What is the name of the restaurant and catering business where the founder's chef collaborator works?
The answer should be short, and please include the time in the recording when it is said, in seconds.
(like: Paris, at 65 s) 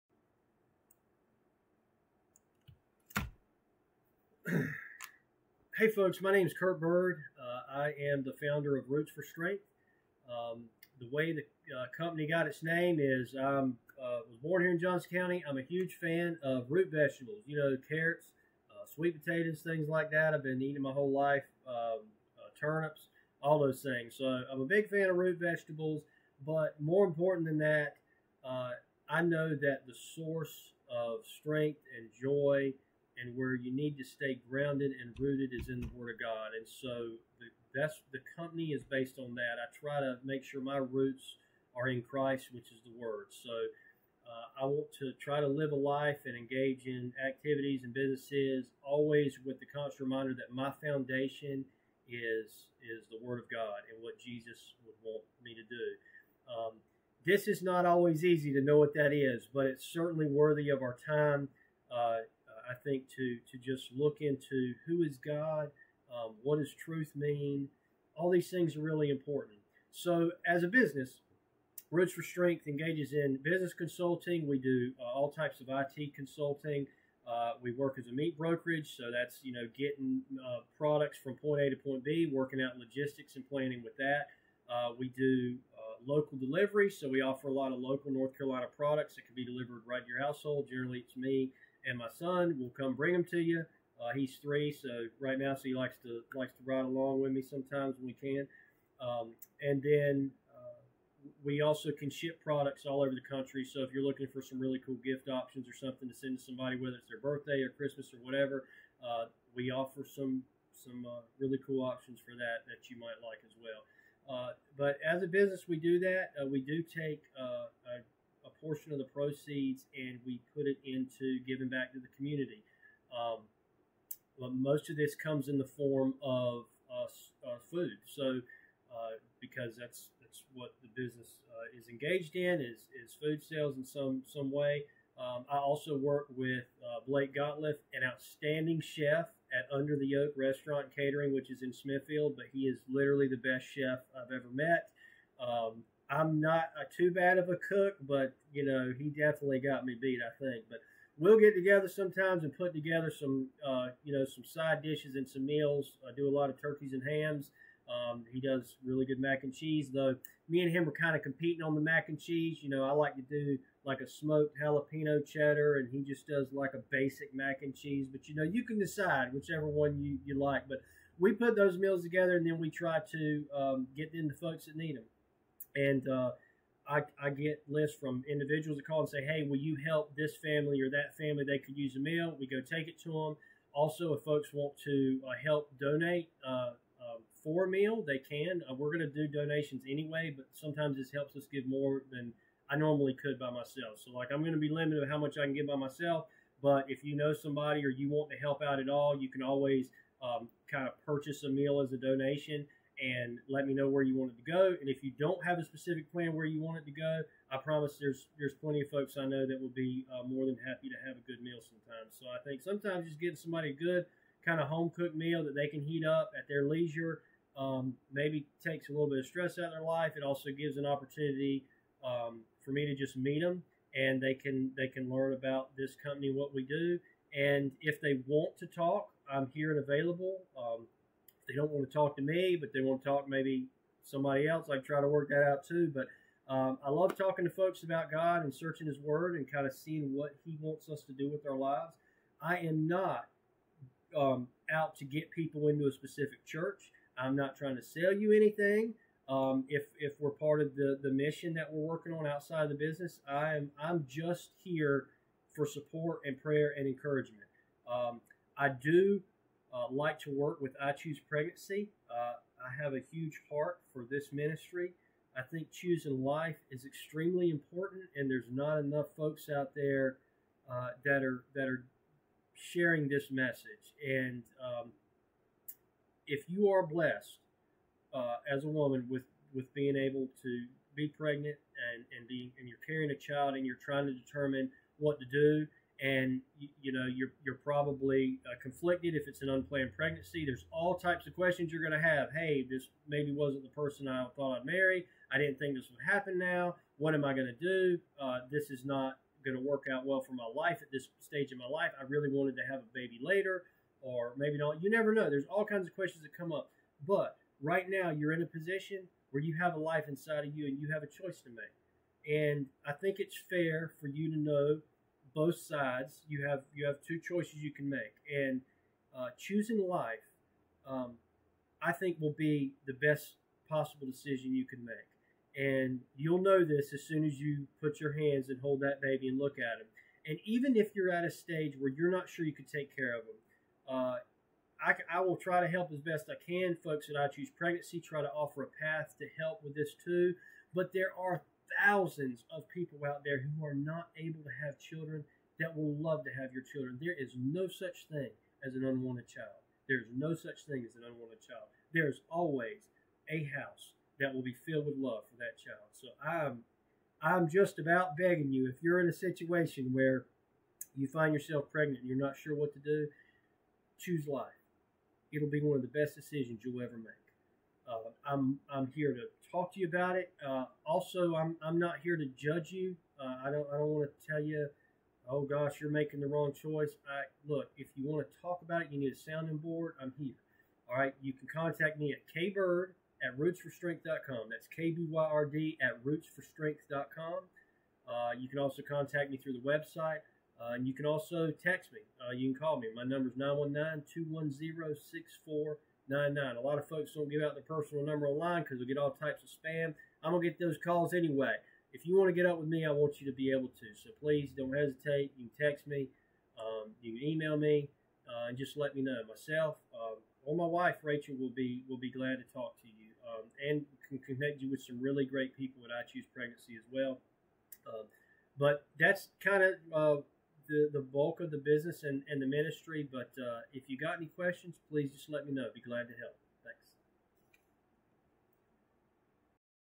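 Under the Oak, at 139 s.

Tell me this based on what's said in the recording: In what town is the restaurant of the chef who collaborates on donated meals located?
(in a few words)
Smithfield.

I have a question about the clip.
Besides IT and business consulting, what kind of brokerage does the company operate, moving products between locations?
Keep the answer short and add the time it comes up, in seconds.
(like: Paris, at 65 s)
Meat brokerage, at 78 s.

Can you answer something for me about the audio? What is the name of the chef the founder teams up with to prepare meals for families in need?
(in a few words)
Blake Gottliff.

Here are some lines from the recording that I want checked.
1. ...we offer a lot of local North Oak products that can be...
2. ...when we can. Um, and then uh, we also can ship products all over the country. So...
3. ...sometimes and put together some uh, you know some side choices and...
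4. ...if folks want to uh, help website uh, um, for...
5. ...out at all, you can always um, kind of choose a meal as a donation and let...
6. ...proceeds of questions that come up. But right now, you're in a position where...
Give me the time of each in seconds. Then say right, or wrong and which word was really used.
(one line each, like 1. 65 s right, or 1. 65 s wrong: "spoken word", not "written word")
1. 87 s wrong: "Carolina", not "Oak"
2. 97 s right
3. 151 s wrong: "dishes", not "choices"
4. 184 s wrong: "donate", not "website"
5. 198 s wrong: "purchase", not "choose"
6. 305 s wrong: "kinds", not "proceeds".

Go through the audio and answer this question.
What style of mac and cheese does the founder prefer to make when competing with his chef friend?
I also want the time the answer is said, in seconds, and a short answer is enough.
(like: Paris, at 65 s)
Smoked jalapeno cheddar, at 164 s.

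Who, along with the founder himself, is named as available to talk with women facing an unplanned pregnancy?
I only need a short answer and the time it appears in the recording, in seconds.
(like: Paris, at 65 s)
Rachel, at 411 s.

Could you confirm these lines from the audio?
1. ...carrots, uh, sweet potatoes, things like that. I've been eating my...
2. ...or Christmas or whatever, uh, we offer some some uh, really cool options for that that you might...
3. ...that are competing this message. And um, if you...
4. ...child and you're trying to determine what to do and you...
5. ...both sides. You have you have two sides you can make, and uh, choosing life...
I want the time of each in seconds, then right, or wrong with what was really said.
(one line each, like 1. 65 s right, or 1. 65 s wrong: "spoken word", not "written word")
1. 17 s right
2. 107 s right
3. 271 s wrong: "sharing", not "competing"
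4. 283 s right
5. 315 s wrong: "choices", not "sides".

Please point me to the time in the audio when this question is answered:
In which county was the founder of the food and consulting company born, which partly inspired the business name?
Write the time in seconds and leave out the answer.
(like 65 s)
14 s.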